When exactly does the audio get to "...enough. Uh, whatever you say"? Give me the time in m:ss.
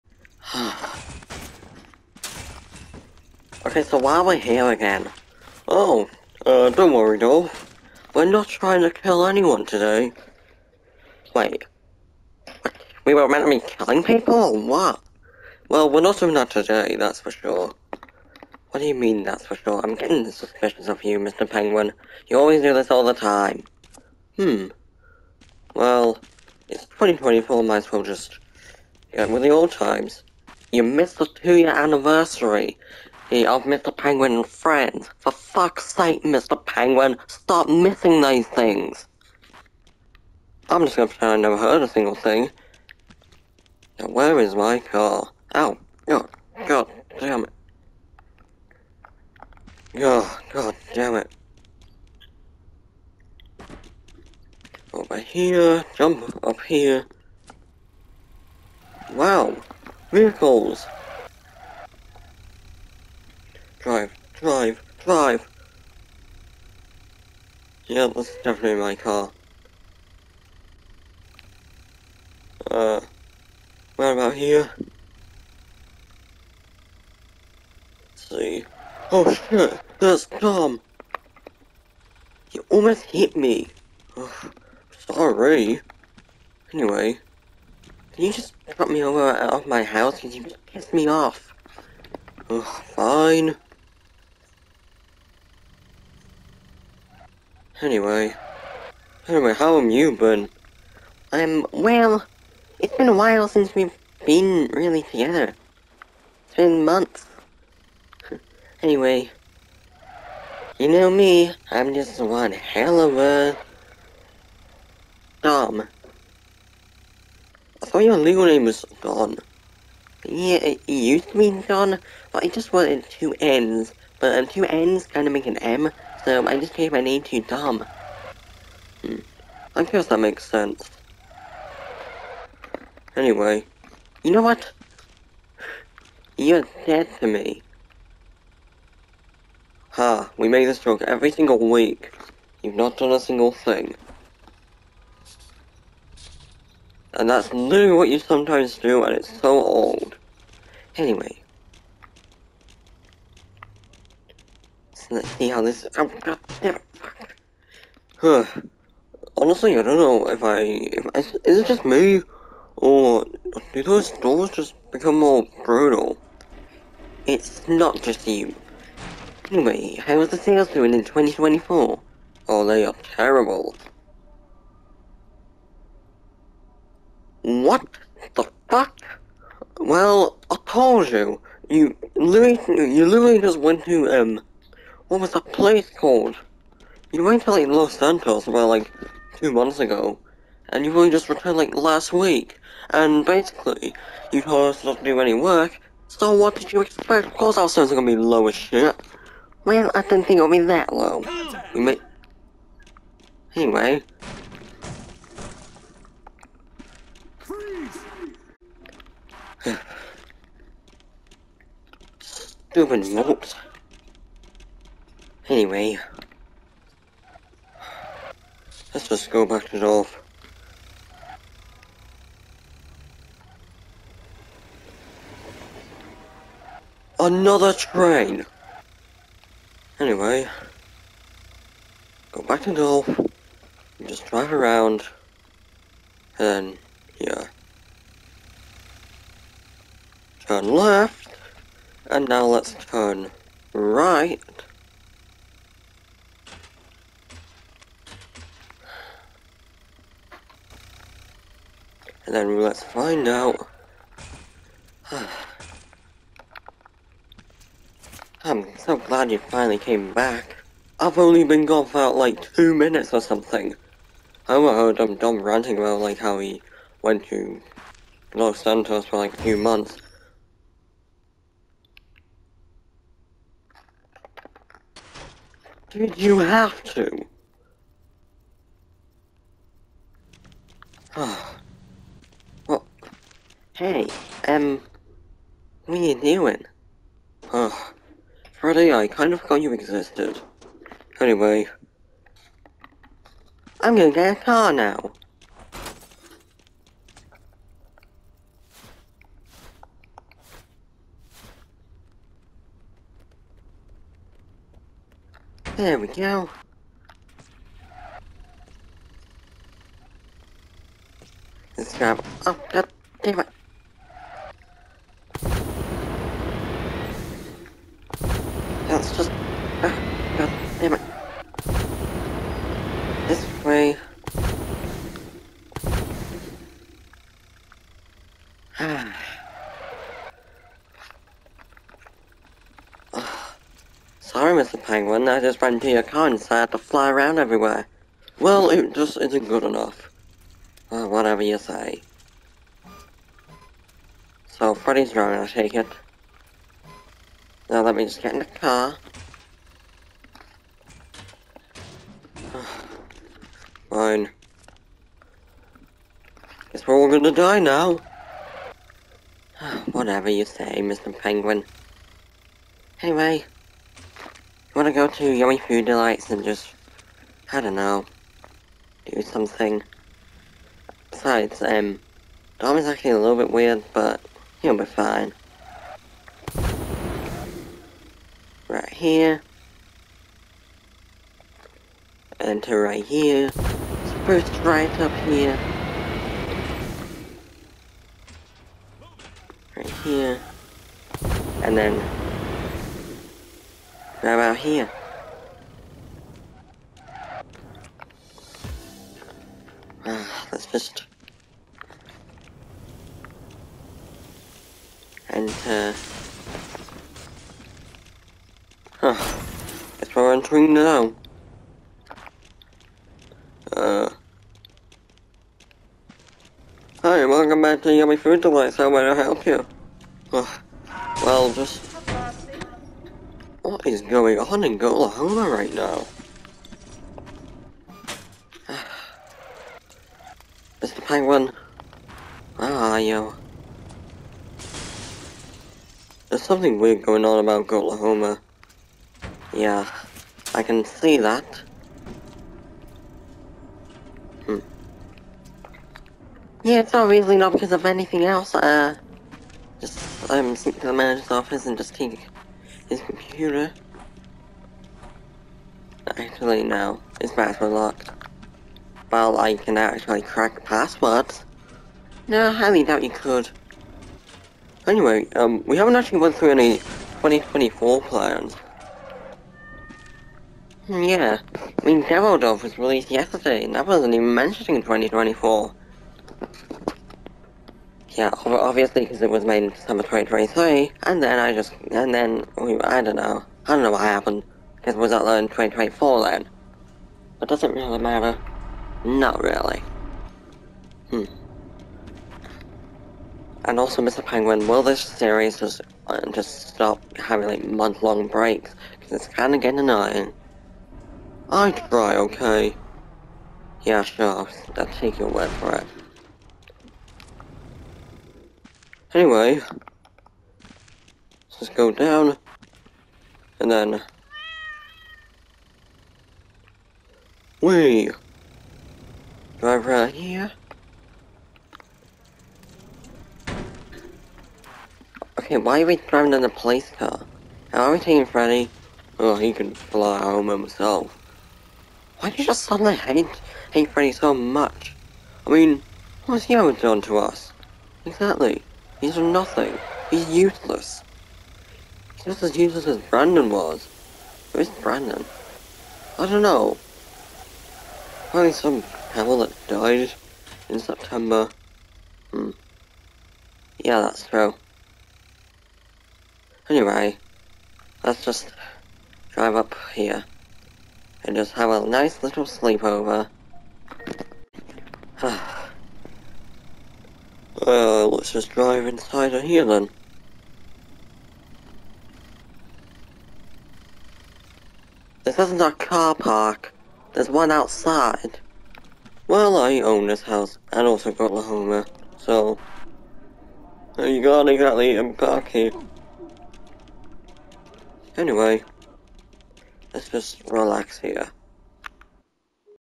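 5:39.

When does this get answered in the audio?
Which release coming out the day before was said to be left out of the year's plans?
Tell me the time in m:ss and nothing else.
7:52.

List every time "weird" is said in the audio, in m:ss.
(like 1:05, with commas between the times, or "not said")
6:13, 7:16.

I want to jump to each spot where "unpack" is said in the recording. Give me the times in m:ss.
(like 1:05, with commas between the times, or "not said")
9:44.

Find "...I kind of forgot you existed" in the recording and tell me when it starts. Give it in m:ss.
4:48.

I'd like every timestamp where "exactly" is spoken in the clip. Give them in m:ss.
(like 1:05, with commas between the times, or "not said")
8:58, 9:44.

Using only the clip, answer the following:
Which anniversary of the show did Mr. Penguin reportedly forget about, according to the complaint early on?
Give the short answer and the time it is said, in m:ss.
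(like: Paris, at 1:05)
two-year, at 0:31.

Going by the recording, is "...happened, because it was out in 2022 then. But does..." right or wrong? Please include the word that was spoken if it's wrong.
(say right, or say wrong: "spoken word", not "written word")
wrong: "2024", not "2022".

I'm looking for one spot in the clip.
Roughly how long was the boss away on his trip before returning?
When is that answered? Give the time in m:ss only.
3:09.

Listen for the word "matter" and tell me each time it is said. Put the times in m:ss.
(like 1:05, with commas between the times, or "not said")
8:07.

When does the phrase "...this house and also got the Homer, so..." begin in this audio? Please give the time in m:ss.
9:40.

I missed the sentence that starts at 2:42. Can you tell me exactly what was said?
Or do those doors just become more brutal?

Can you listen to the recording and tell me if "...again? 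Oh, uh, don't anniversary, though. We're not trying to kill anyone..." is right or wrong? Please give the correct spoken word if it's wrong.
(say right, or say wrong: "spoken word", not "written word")
wrong: "worry", not "anniversary".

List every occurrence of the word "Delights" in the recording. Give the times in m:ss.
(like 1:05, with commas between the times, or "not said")
6:05, 6:58.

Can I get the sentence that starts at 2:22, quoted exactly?
You've not done a single thing.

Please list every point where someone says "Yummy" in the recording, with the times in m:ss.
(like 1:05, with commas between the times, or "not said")
6:05, 6:57.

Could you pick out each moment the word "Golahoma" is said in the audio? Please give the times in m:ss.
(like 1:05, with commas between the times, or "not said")
7:04, 7:17.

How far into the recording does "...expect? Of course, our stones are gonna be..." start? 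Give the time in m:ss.
3:16.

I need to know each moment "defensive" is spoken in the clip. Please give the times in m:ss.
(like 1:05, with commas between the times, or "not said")
not said.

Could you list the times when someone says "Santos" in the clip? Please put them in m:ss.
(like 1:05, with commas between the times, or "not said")
3:07, 4:28.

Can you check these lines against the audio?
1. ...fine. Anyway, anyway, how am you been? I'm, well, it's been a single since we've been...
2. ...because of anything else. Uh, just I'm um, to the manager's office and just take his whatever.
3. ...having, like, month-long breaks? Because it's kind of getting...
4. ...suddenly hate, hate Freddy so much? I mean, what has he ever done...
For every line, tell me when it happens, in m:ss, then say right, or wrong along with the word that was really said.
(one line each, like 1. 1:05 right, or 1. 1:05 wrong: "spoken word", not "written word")
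1. 1:32 wrong: "while", not "single"
2. 7:27 wrong: "computer", not "whatever"
3. 8:17 right
4. 8:52 right.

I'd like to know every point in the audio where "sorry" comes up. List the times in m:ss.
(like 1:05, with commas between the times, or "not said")
1:25, 5:34.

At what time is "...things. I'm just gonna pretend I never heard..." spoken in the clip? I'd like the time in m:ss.
0:38.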